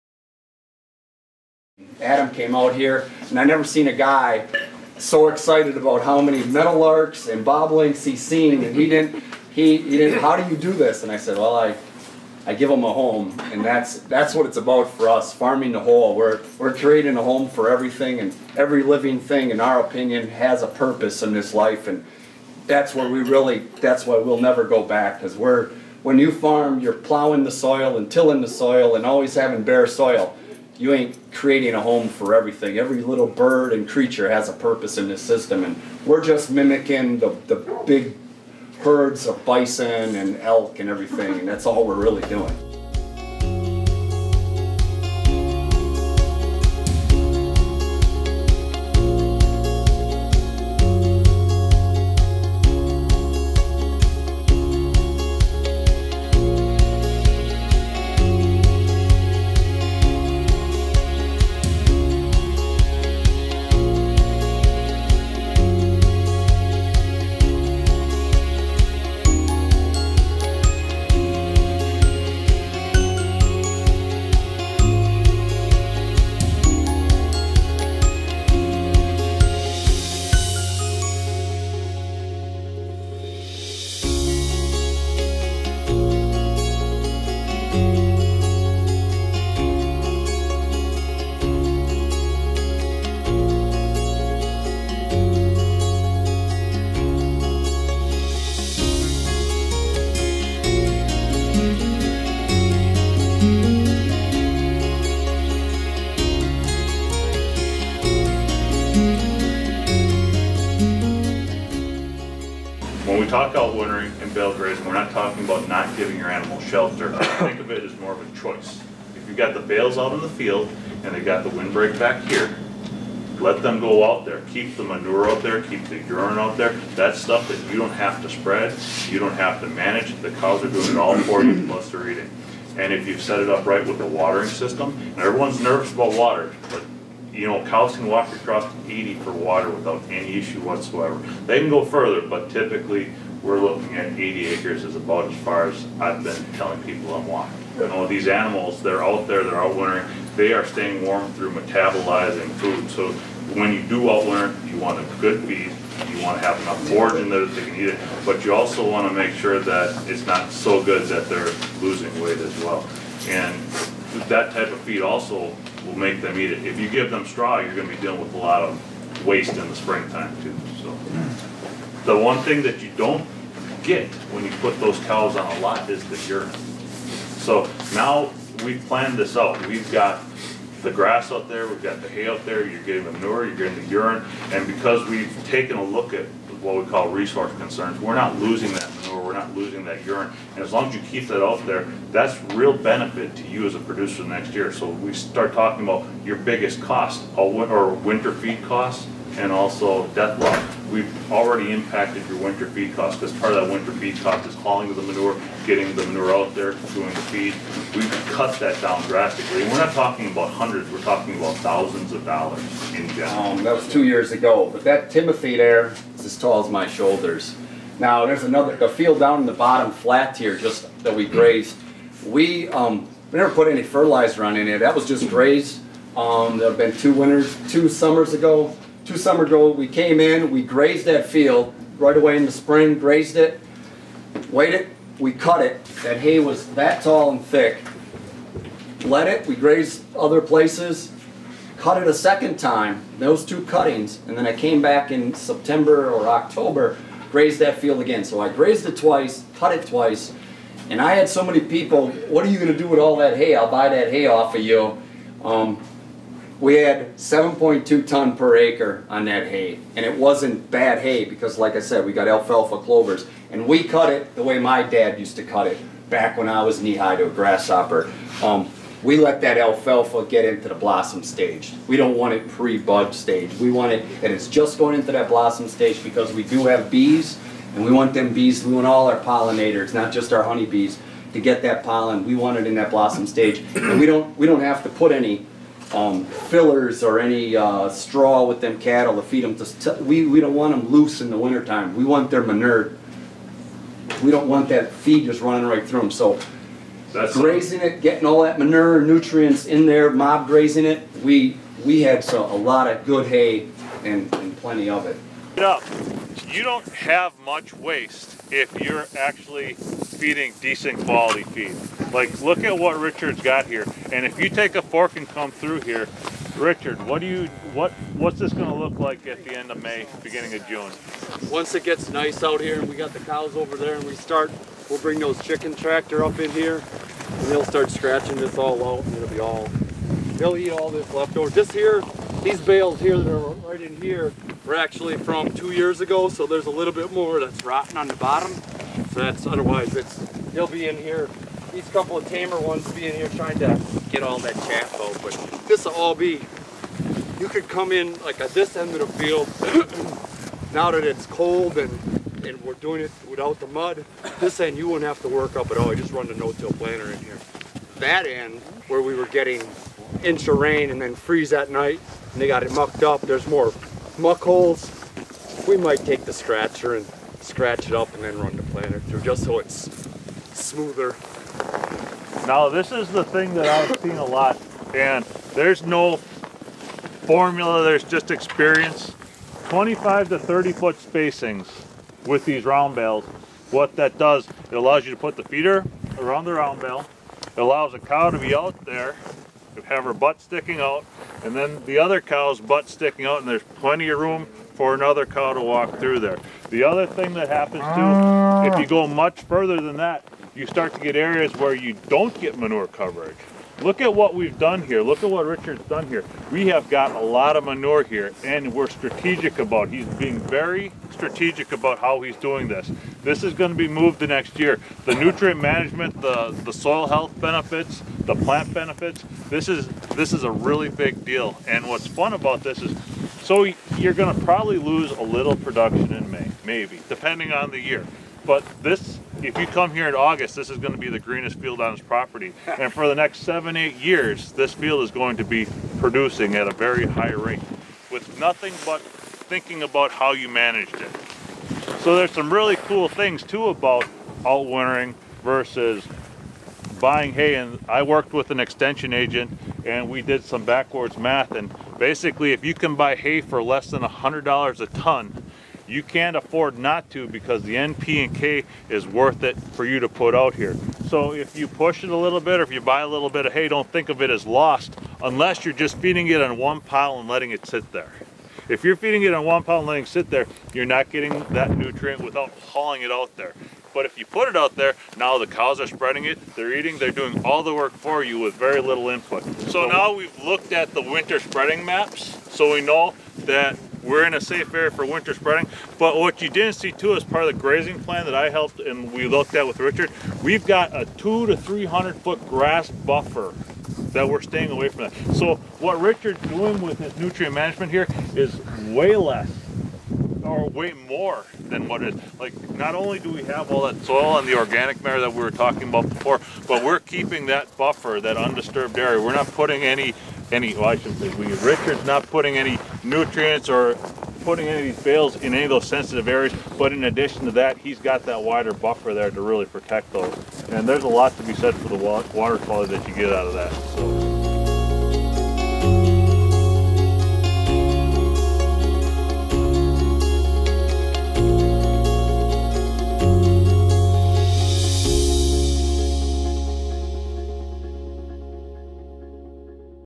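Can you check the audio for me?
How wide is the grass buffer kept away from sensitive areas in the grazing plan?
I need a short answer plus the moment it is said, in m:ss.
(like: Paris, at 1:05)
200 to 300 feet, at 8:11.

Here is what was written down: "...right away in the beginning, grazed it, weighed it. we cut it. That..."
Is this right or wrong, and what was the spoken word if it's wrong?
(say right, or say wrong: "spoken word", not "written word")
wrong: "spring", not "beginning".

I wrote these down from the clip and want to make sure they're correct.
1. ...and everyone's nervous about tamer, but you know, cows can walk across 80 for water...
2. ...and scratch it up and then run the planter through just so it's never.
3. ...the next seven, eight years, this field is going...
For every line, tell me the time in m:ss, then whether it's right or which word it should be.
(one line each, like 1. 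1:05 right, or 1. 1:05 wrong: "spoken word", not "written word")
1. 2:15 wrong: "water", not "tamer"
2. 6:06 wrong: "smoother", not "never"
3. 7:13 right.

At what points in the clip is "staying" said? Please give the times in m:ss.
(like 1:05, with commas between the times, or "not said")
2:30, 8:14.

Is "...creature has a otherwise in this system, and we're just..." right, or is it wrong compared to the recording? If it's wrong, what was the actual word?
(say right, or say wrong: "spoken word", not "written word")
wrong: "purpose", not "otherwise".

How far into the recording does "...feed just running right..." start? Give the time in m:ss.
4:54.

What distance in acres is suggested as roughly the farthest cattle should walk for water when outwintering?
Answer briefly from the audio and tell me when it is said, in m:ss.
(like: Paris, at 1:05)
80 acres, at 2:24.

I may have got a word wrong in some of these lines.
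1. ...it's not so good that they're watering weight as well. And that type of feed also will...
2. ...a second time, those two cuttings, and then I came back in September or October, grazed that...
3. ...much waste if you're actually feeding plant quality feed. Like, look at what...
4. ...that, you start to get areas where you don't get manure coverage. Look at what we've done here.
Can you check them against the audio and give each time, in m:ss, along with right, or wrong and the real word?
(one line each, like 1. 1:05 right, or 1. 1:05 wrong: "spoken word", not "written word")
1. 2:40 wrong: "losing", not "watering"
2. 4:02 right
3. 5:07 wrong: "decent", not "plant"
4. 6:39 right.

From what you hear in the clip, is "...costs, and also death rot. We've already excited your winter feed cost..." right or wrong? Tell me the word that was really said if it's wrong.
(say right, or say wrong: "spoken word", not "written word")
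wrong: "impacted", not "excited".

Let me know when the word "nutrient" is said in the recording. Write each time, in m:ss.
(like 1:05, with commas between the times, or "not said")
4:59, 6:55, 7:51, 8:17, 8:33.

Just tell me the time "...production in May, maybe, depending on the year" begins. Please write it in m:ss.
7:05.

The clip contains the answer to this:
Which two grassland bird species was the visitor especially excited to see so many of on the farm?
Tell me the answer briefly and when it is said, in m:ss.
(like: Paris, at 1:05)
meadowlarks and bobolinks, at 0:06.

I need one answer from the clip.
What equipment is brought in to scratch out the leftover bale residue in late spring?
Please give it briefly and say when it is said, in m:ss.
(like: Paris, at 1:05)
chicken tractor, at 5:25.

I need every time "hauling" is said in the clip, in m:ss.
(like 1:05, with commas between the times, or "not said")
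3:24, 7:52.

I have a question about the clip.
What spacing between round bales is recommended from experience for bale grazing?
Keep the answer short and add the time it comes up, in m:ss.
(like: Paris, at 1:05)
25 to 30 feet, at 6:19.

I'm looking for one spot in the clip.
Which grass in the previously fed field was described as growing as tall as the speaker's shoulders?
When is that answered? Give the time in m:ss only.
3:35.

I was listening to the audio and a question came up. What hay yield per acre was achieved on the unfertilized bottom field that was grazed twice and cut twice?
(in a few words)
7.2 tons.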